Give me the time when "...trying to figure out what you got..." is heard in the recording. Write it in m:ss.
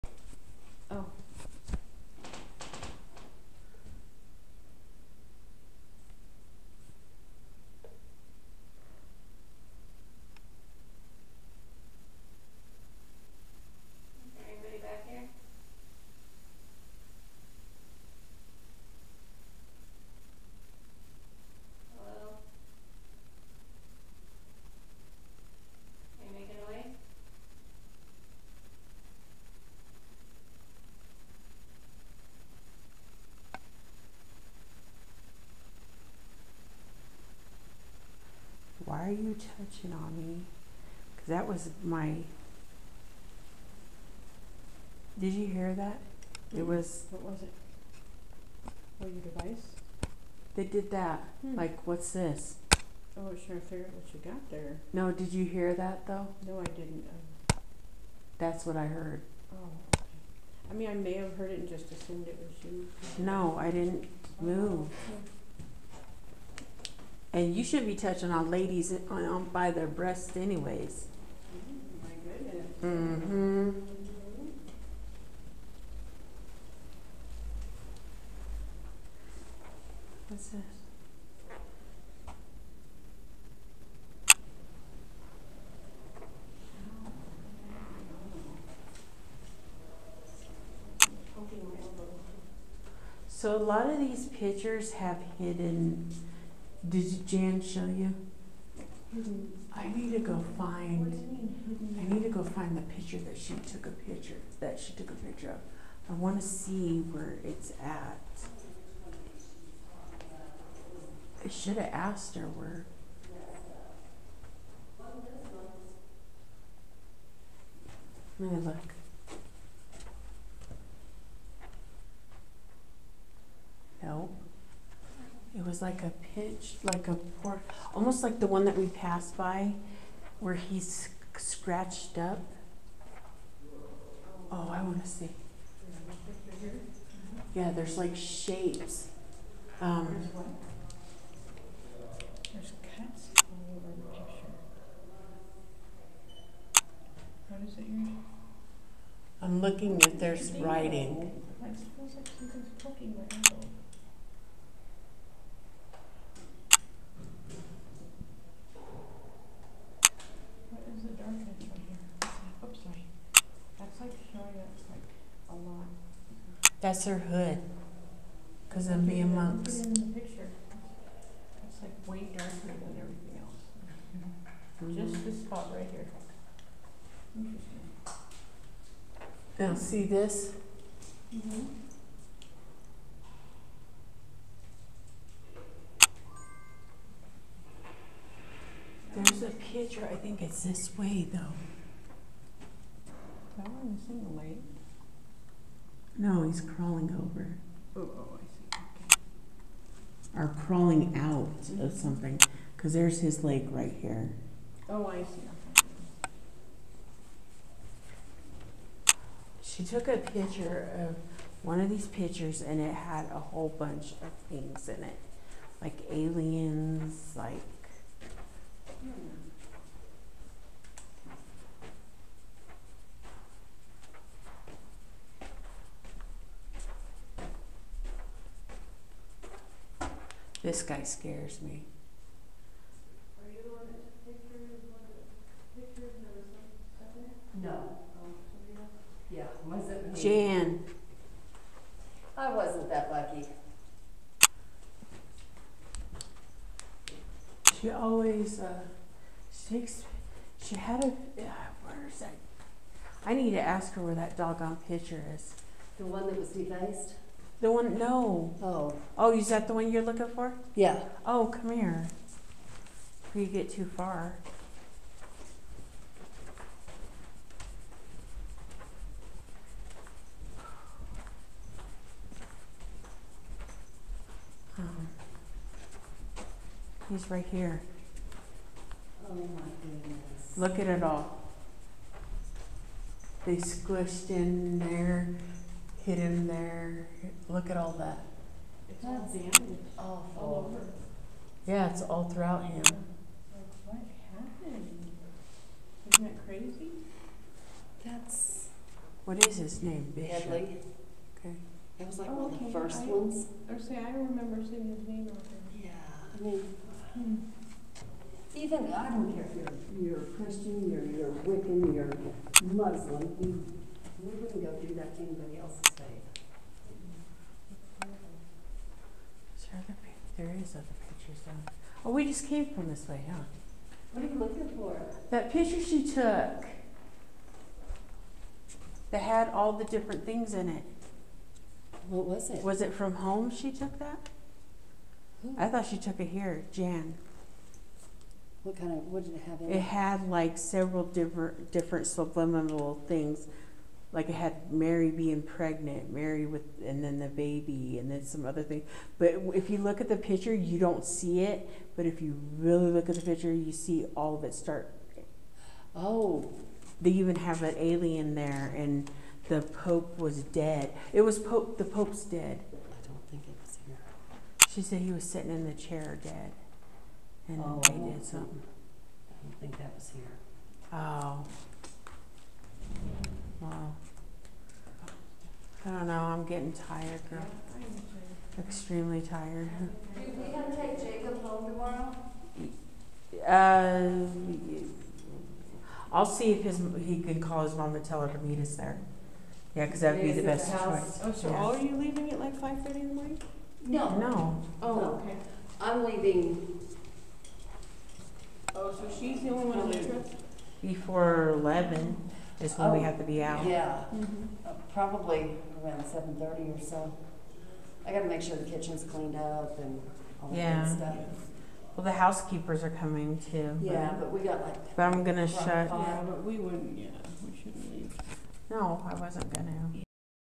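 0:53.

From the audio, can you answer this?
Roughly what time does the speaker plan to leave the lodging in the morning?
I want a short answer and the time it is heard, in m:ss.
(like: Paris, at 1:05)
7:30, at 6:46.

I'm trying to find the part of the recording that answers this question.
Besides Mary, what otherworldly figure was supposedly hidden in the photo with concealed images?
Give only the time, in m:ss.
5:57.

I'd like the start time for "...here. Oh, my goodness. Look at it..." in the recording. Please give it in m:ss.
4:37.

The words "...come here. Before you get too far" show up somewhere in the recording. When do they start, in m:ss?
4:21.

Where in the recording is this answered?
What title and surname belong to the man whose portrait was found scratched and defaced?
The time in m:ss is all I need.
5:00.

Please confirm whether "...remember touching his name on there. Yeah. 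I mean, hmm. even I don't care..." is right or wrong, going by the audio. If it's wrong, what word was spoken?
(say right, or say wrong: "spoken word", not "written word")
wrong: "seeing", not "touching".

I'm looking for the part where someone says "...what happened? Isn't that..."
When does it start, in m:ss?
4:53.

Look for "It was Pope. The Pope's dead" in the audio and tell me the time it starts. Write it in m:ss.
6:01.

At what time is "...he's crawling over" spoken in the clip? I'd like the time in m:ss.
3:16.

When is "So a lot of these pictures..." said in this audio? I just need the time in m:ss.
1:33.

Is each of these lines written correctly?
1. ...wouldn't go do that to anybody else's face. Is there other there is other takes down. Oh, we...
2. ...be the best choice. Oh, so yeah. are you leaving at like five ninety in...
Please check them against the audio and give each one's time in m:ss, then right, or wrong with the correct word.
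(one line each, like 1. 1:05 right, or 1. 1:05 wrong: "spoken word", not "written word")
1. 5:14 wrong: "pictures", not "takes"
2. 6:30 wrong: "thirty", not "ninety".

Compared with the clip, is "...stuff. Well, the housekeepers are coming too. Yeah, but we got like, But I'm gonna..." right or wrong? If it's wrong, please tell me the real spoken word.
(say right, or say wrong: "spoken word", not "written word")
right.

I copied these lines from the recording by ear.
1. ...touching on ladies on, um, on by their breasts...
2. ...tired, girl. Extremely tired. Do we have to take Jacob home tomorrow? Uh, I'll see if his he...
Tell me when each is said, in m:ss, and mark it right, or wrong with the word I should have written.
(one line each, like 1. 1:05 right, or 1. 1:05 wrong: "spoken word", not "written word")
1. 1:07 right
2. 6:16 right.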